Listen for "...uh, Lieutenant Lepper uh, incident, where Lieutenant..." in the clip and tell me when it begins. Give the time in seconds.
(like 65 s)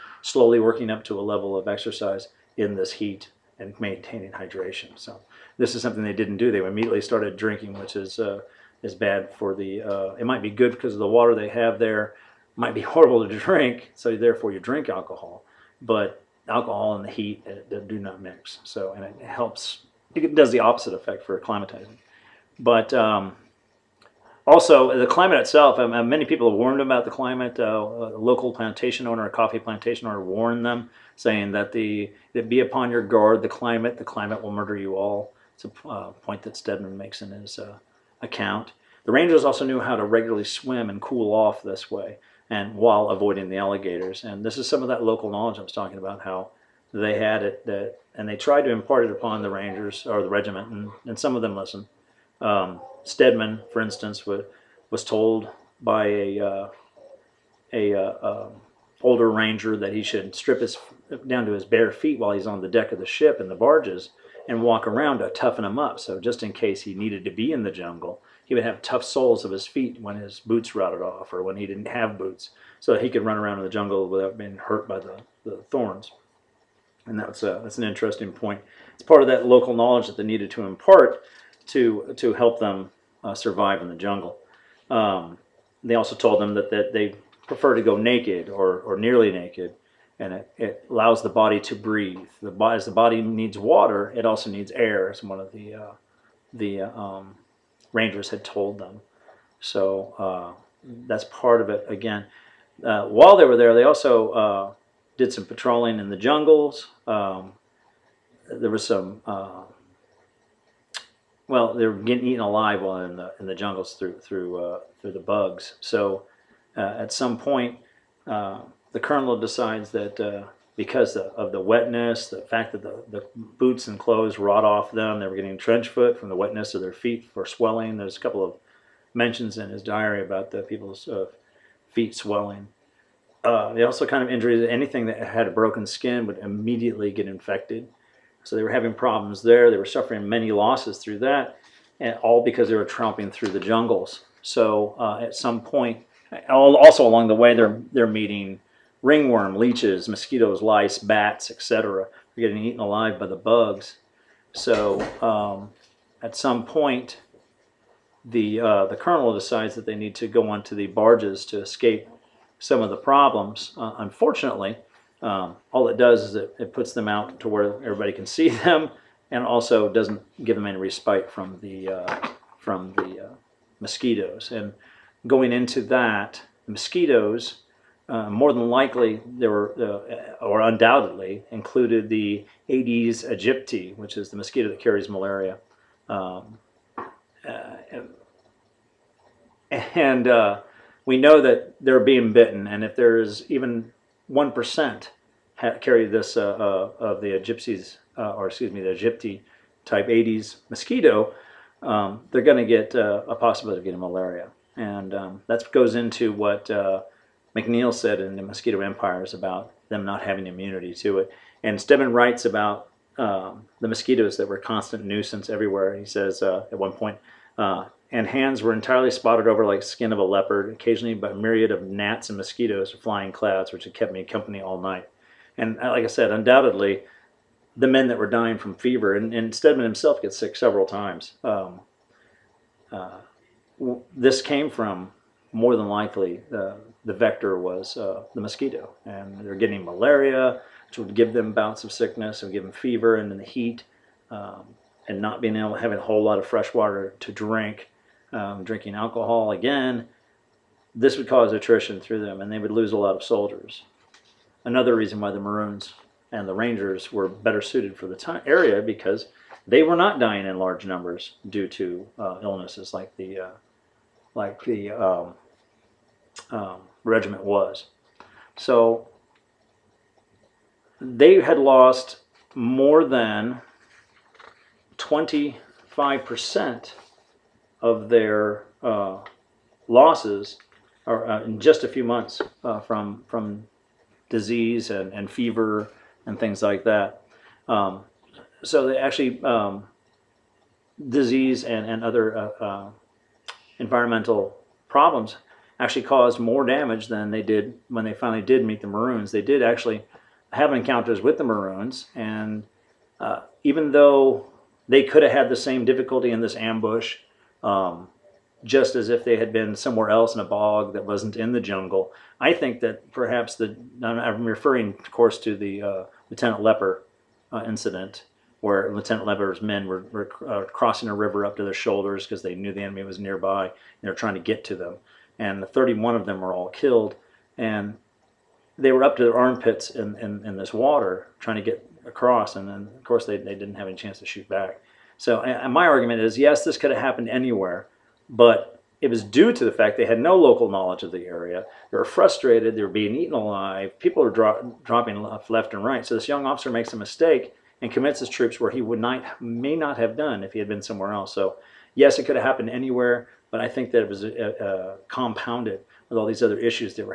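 315 s.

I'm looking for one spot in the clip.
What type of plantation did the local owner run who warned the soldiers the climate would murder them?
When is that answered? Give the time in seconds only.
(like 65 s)
29 s.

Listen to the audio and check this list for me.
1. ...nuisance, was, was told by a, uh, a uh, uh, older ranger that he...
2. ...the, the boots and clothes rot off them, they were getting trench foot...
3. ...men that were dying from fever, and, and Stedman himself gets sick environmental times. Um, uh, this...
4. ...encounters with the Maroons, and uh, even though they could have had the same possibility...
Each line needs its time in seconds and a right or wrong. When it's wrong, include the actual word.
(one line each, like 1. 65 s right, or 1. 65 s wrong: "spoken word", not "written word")
1. 53 s wrong: "instance", not "nuisance"
2. 122 s right
3. 227 s wrong: "several", not "environmental"
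4. 300 s wrong: "difficulty", not "possibility".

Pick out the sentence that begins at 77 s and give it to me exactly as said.
And that's, a, uh, that's an interesting point.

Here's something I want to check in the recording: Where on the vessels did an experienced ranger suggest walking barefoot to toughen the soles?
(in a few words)
In the barges.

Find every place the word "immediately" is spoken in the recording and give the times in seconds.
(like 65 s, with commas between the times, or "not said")
6 s, 136 s.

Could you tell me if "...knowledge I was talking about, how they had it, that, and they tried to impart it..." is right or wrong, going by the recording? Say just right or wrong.
right.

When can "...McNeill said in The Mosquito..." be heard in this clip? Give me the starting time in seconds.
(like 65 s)
207 s.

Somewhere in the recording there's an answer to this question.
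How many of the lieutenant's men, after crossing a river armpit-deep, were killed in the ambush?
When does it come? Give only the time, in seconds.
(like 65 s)
325 s.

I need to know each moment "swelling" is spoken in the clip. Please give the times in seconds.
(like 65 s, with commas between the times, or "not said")
127 s, 132 s.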